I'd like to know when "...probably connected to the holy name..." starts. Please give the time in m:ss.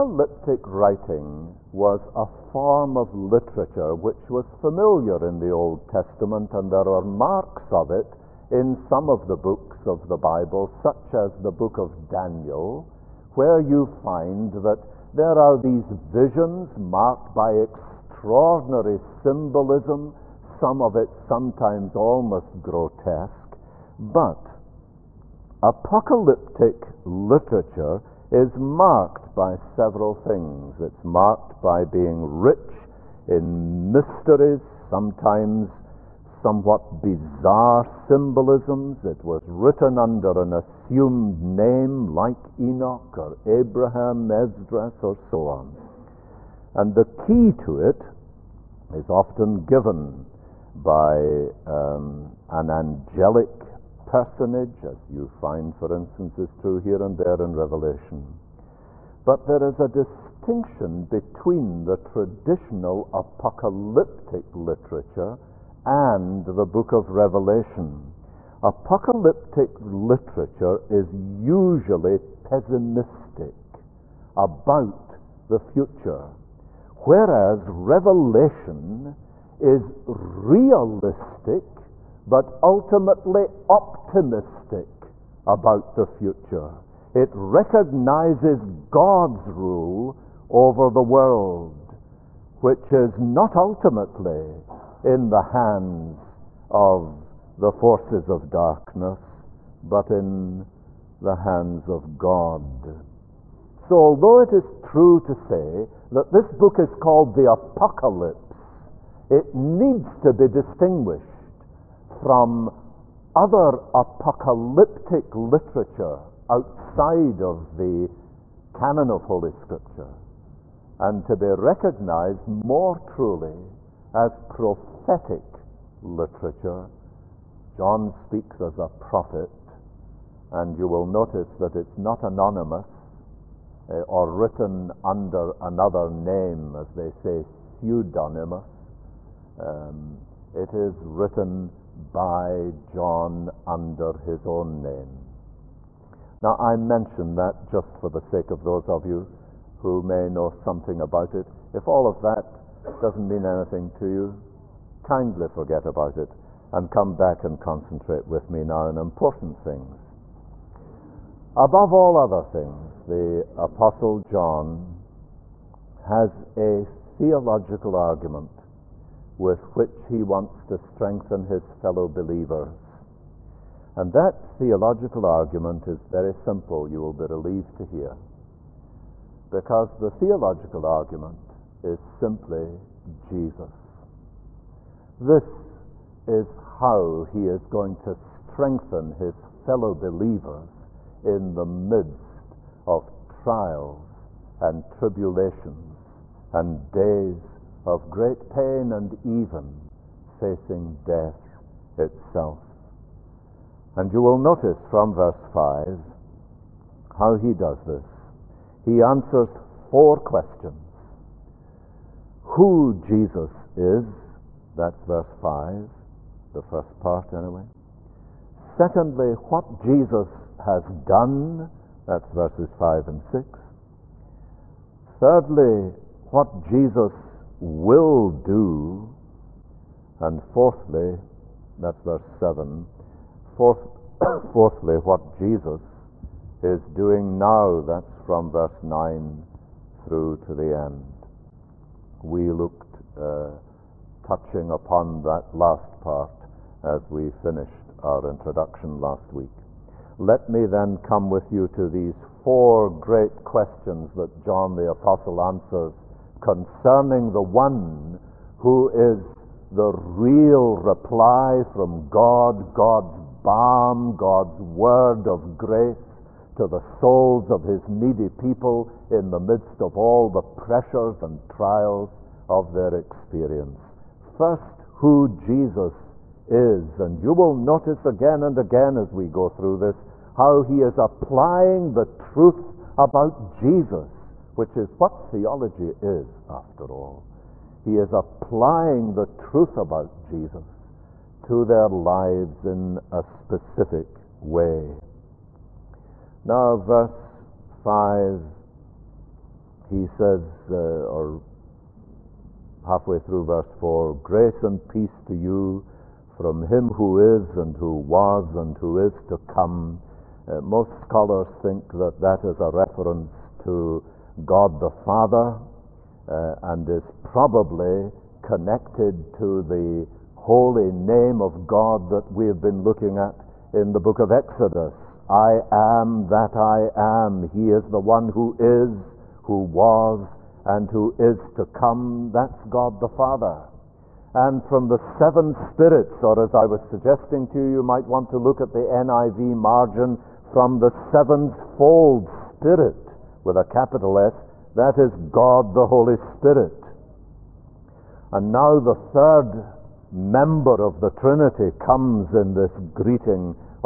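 5:17.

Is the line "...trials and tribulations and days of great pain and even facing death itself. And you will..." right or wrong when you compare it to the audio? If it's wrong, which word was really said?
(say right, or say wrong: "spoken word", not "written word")
right.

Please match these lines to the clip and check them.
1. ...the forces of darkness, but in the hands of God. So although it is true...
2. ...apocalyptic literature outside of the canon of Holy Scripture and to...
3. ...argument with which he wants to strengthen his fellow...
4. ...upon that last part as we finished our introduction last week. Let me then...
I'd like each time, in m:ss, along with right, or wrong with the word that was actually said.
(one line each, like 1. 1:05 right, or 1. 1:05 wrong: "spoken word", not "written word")
1. 1:37 right
2. 1:53 right
3. 2:47 right
4. 4:04 right.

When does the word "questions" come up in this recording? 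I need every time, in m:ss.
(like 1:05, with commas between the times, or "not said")
3:30, 4:13.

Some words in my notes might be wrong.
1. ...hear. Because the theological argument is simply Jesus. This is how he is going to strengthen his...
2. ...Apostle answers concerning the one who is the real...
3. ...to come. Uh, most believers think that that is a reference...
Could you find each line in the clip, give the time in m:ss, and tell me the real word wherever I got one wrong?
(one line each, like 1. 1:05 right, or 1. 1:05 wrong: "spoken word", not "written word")
1. 2:57 right
2. 4:14 right
3. 5:09 wrong: "scholars", not "believers".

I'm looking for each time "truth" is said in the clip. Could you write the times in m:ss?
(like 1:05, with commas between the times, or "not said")
4:42, 4:49.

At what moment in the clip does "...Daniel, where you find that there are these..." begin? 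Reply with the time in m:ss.
0:12.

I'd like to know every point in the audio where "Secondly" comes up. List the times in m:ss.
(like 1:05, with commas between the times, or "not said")
3:38.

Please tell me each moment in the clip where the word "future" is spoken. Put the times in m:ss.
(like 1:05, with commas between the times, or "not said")
1:15, 1:26.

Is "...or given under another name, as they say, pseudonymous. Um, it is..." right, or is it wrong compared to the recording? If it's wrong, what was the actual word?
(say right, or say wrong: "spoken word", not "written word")
wrong: "written", not "given".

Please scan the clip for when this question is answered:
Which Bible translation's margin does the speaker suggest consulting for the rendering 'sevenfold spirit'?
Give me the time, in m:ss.
5:38.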